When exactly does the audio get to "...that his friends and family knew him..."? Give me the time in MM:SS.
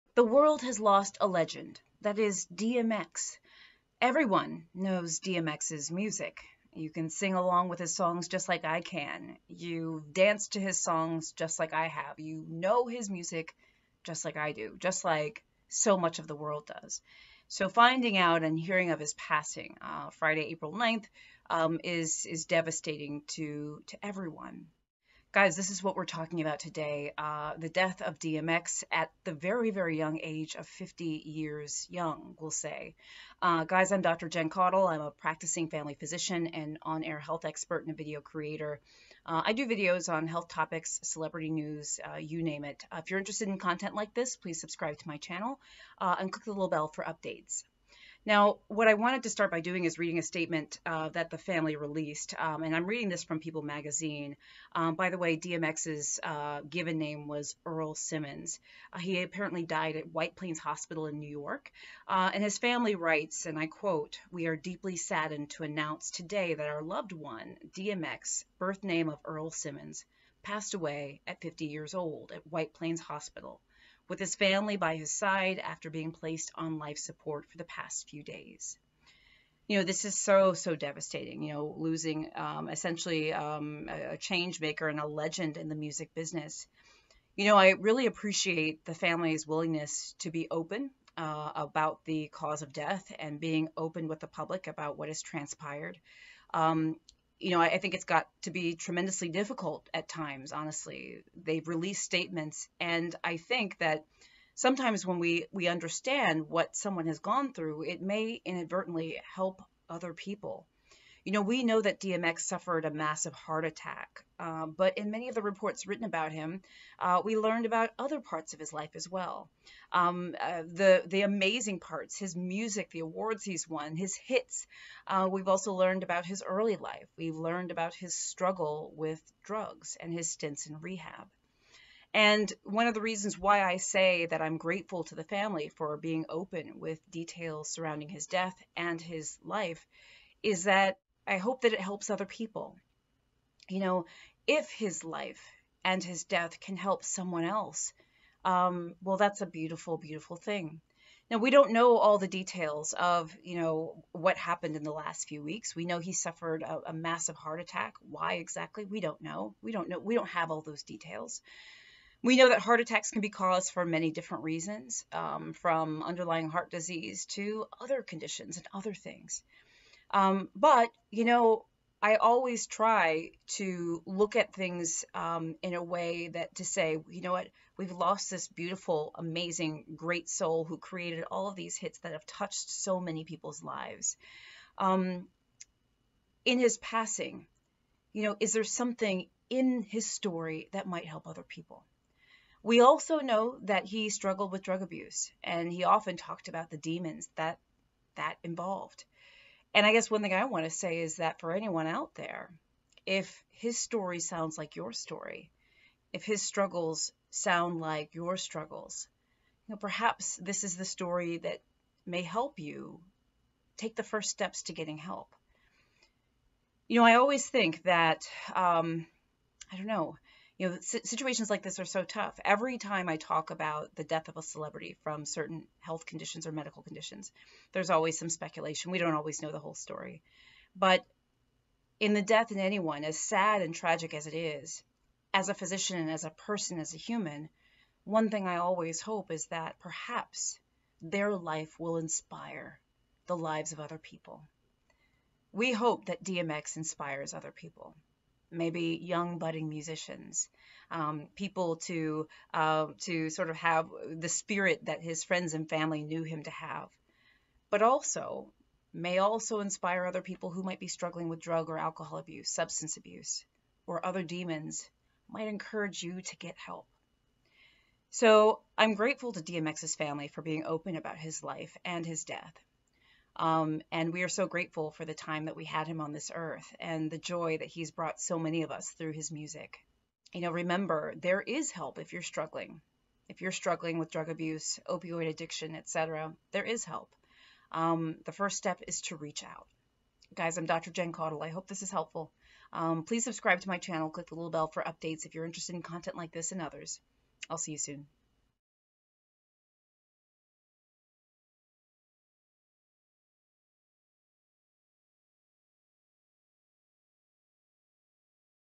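04:14.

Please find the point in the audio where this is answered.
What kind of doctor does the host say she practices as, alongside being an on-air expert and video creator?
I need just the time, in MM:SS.
00:35.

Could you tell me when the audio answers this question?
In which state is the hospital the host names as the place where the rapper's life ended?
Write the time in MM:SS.
01:01.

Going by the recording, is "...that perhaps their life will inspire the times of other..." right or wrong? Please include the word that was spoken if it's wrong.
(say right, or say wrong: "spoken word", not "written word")
wrong: "lives", not "times".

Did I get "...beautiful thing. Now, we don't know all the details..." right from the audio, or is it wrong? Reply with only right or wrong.
right.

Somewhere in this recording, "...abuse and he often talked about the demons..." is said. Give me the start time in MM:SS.
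03:14.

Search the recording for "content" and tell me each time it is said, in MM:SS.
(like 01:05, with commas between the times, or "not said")
00:43, 04:55.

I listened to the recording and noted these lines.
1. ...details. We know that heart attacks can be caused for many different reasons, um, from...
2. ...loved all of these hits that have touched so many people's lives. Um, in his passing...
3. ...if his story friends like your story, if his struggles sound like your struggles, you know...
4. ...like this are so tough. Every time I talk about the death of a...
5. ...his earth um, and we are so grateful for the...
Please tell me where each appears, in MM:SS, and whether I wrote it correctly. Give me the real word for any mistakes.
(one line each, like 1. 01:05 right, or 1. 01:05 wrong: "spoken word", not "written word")
1. 02:40 right
2. 03:00 wrong: "created", not "loved"
3. 03:23 wrong: "sounds", not "friends"
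4. 03:41 right
5. 04:32 wrong: "death", not "earth".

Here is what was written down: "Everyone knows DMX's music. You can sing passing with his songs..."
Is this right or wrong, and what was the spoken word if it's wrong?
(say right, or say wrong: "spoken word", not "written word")
wrong: "along", not "passing".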